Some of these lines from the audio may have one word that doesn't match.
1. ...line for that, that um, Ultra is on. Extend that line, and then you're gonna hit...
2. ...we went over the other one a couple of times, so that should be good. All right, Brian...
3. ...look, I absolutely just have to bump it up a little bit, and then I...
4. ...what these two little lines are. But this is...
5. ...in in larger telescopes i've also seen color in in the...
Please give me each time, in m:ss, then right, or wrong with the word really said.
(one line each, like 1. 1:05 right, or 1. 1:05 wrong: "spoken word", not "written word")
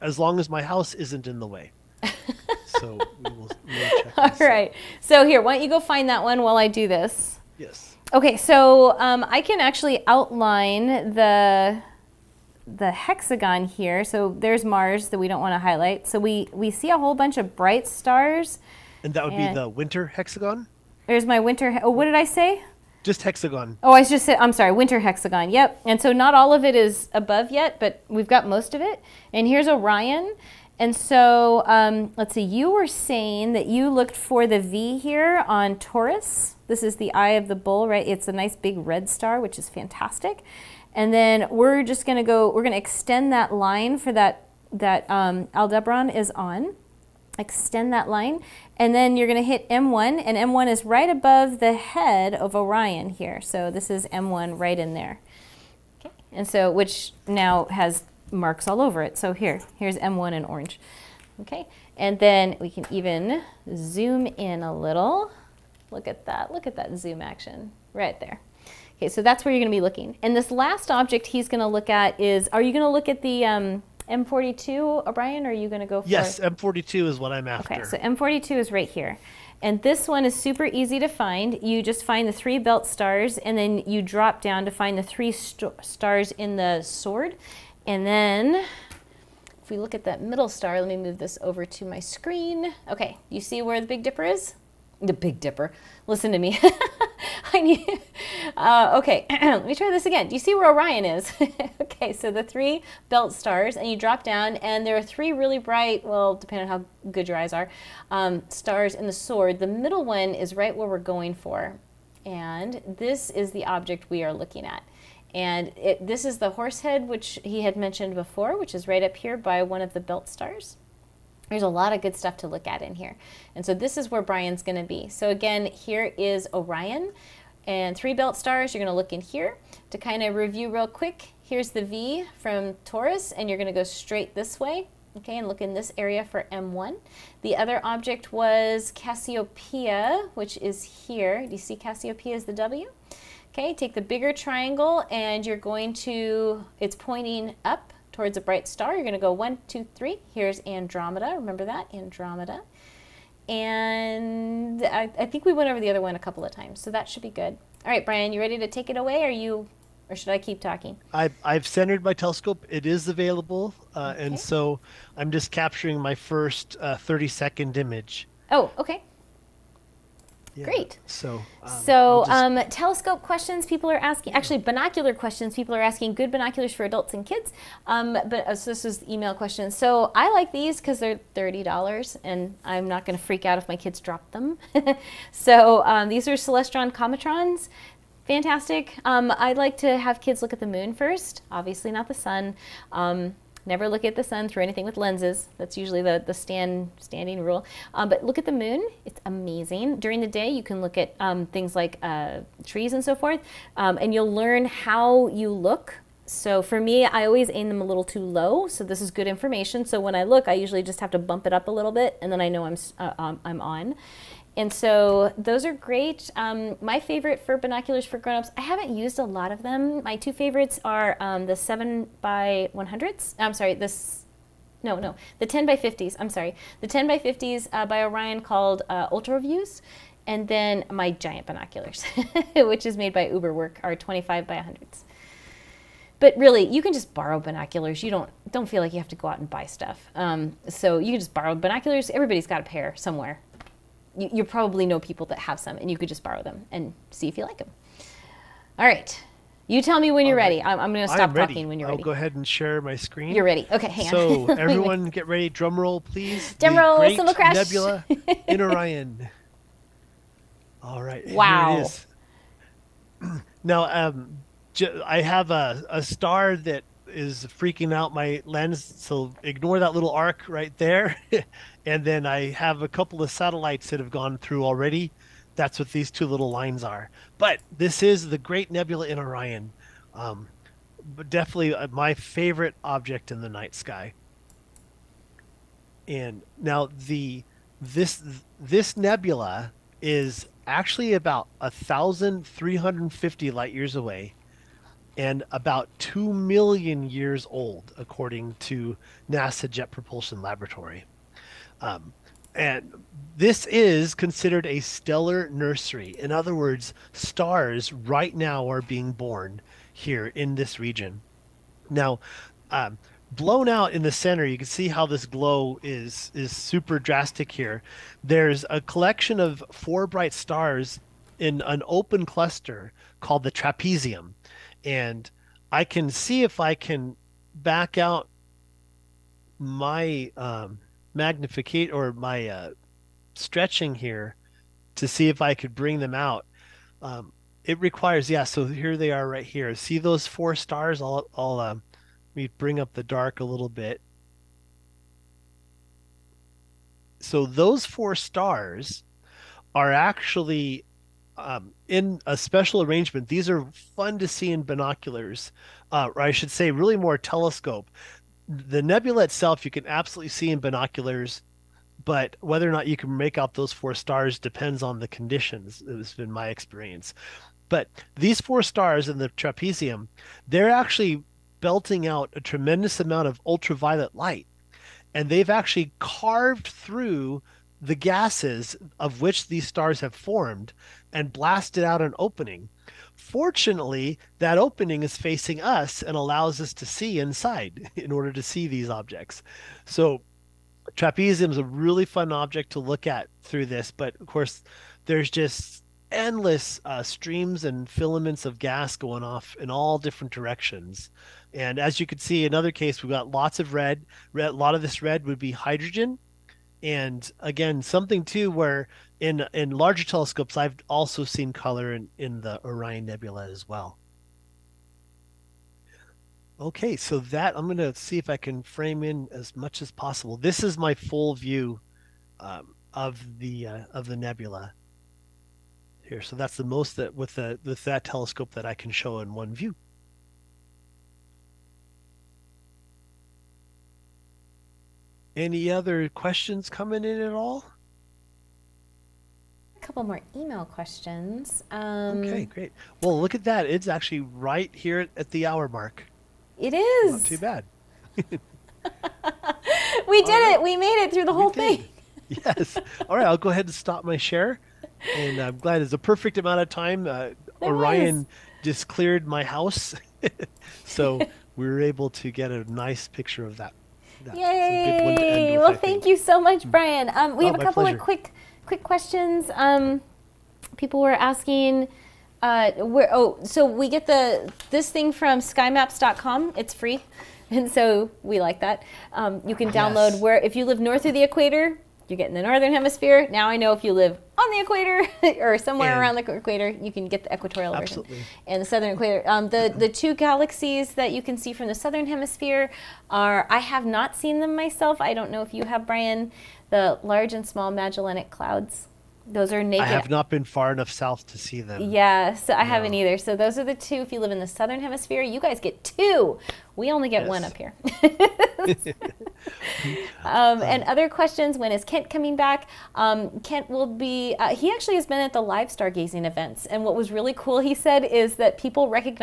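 1. 0:43 wrong: "Aldebaran", not "Ultra"
2. 2:35 right
3. 3:30 wrong: "usually", not "absolutely"
4. 4:35 right
5. 6:49 right.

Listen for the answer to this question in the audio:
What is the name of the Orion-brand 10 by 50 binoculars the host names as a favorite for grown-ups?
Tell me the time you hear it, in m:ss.
3:49.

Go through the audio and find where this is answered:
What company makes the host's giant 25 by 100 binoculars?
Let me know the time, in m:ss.
3:53.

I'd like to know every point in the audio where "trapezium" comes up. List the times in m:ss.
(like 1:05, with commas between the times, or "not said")
5:23, 6:09, 6:30.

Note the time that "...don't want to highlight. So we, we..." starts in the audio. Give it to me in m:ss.
0:15.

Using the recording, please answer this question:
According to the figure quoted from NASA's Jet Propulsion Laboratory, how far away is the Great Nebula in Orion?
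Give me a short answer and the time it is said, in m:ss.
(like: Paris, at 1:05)
1,350 light years, at 4:51.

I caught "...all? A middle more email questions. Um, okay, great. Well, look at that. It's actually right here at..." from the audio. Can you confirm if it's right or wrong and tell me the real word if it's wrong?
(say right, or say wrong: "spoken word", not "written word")
wrong: "couple", not "middle".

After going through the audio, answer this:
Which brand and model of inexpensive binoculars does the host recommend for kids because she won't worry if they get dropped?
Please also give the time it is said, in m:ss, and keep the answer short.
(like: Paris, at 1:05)
Celestron Cometrons, at 3:06.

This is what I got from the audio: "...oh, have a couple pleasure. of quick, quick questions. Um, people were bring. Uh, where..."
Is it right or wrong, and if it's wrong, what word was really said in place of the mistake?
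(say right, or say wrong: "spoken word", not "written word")
wrong: "asking", not "bring".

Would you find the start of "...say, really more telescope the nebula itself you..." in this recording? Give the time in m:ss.
5:56.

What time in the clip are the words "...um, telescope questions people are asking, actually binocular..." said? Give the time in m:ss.
2:52.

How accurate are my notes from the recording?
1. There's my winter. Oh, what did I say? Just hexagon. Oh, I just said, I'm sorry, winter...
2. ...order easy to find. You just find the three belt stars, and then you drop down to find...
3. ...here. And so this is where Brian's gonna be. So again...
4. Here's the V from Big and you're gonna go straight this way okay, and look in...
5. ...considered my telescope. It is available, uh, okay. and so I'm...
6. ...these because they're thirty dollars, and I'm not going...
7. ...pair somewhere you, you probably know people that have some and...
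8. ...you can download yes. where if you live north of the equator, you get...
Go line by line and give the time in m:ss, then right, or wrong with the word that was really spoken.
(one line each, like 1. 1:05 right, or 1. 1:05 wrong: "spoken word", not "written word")
1. 0:21 right
2. 1:20 wrong: "super", not "order"
3. 2:02 right
4. 2:11 wrong: "Taurus", not "Big"
5. 2:41 wrong: "centered", not "considered"
6. 3:00 right
7. 4:02 right
8. 7:59 right.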